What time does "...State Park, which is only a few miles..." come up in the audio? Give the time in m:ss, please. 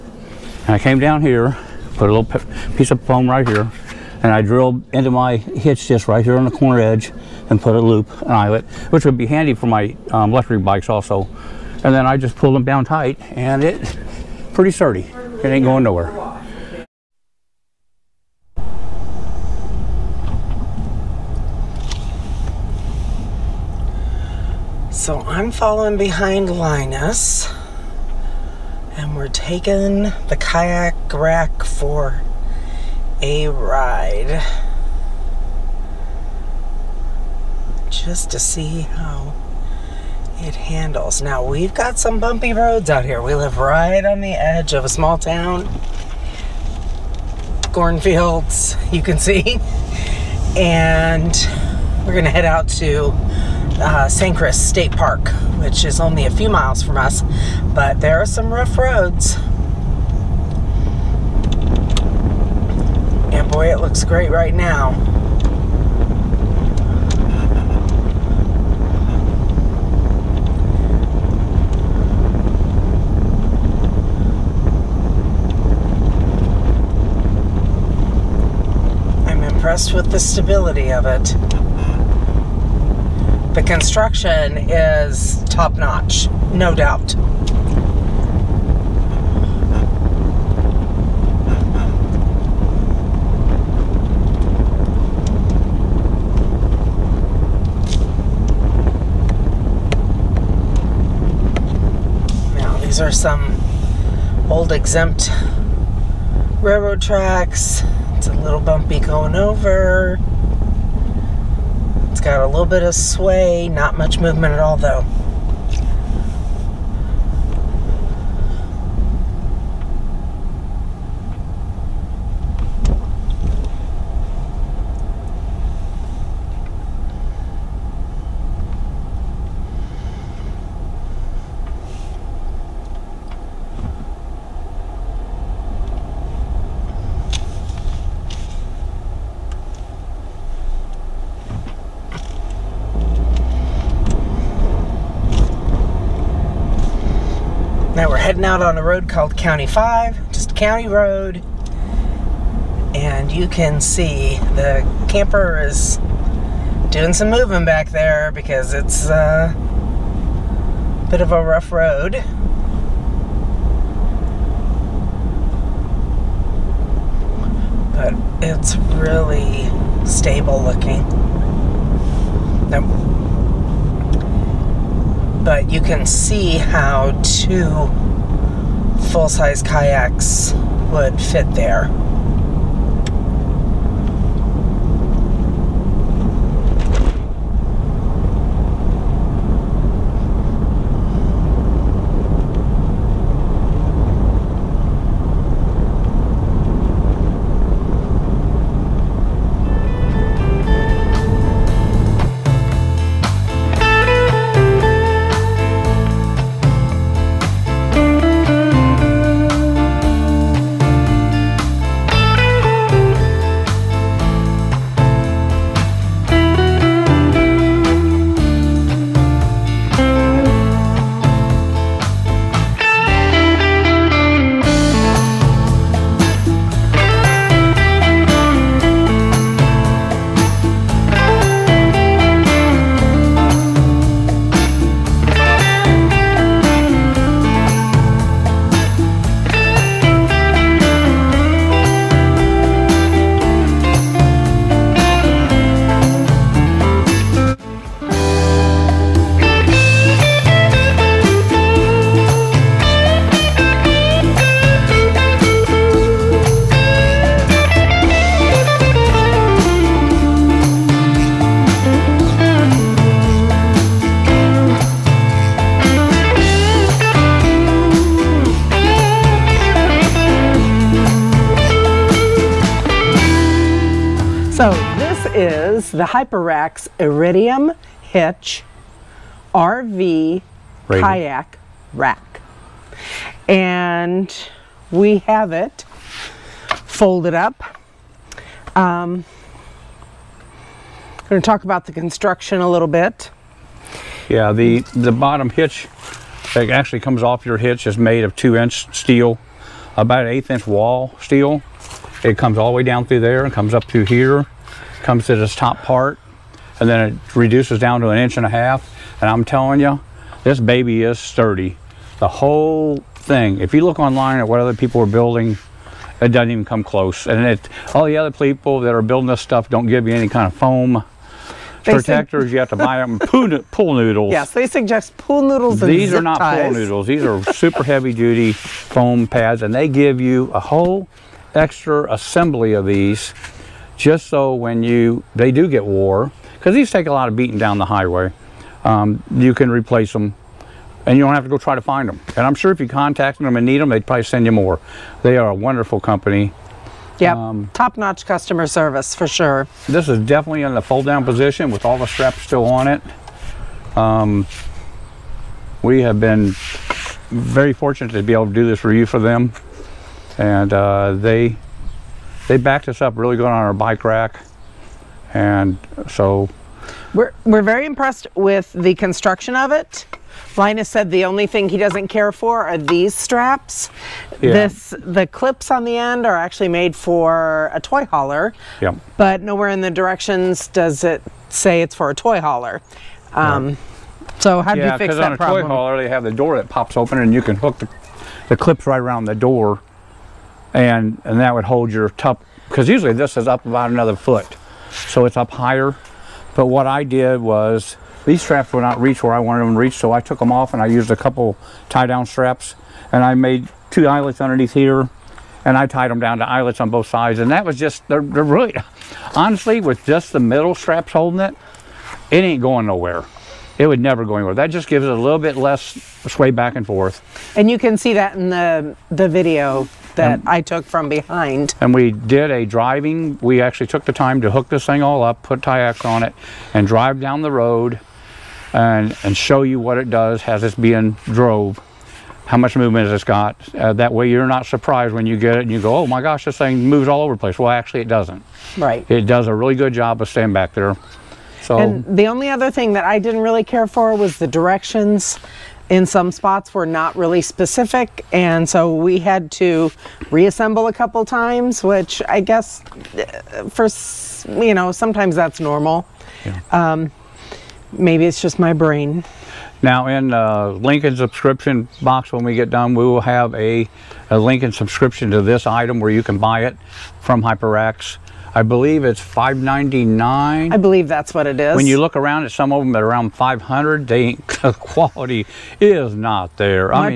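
0:54.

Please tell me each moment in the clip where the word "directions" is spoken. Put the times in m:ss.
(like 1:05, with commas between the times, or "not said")
6:19, 7:24.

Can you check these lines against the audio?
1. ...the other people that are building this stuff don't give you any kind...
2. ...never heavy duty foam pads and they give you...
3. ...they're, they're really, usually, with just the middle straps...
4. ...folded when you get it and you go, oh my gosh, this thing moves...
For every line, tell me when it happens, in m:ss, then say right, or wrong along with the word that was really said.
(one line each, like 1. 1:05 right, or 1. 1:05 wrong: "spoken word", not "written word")
1. 5:18 right
2. 5:27 wrong: "super", not "never"
3. 6:48 wrong: "honestly", not "usually"
4. 7:14 wrong: "surprised", not "folded".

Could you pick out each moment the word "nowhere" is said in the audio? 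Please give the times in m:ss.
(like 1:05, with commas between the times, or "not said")
0:15, 6:19, 6:52.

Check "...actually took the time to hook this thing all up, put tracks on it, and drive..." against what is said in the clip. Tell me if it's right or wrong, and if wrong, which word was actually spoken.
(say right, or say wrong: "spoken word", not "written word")
wrong: "kayaks", not "tracks".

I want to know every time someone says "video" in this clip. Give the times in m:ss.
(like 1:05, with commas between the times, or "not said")
6:59.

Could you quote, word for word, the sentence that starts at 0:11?
And then I just pulled them down tight and it pretty sturdy.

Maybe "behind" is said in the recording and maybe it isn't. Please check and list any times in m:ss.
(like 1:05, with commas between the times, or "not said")
0:25, 7:01.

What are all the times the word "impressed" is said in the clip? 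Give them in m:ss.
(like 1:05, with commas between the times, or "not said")
1:19, 6:07.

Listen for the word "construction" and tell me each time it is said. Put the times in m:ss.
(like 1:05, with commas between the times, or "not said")
1:23, 4:51, 6:08.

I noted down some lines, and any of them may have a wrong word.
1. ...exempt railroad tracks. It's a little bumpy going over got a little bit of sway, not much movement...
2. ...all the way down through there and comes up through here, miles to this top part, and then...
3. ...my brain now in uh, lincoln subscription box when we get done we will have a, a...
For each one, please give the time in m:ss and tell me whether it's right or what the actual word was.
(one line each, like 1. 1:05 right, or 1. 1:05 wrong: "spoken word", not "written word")
1. 1:44 right
2. 5:02 wrong: "comes", not "miles"
3. 7:38 right.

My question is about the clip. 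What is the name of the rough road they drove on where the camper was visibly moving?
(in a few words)
County 5.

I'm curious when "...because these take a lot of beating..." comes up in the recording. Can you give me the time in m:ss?
5:36.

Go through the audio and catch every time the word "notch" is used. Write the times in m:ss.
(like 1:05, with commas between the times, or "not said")
1:25, 5:47.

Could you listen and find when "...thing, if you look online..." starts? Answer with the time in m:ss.
5:13.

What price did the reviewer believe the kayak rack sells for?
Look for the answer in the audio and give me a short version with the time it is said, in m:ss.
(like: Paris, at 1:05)
599, at 7:49.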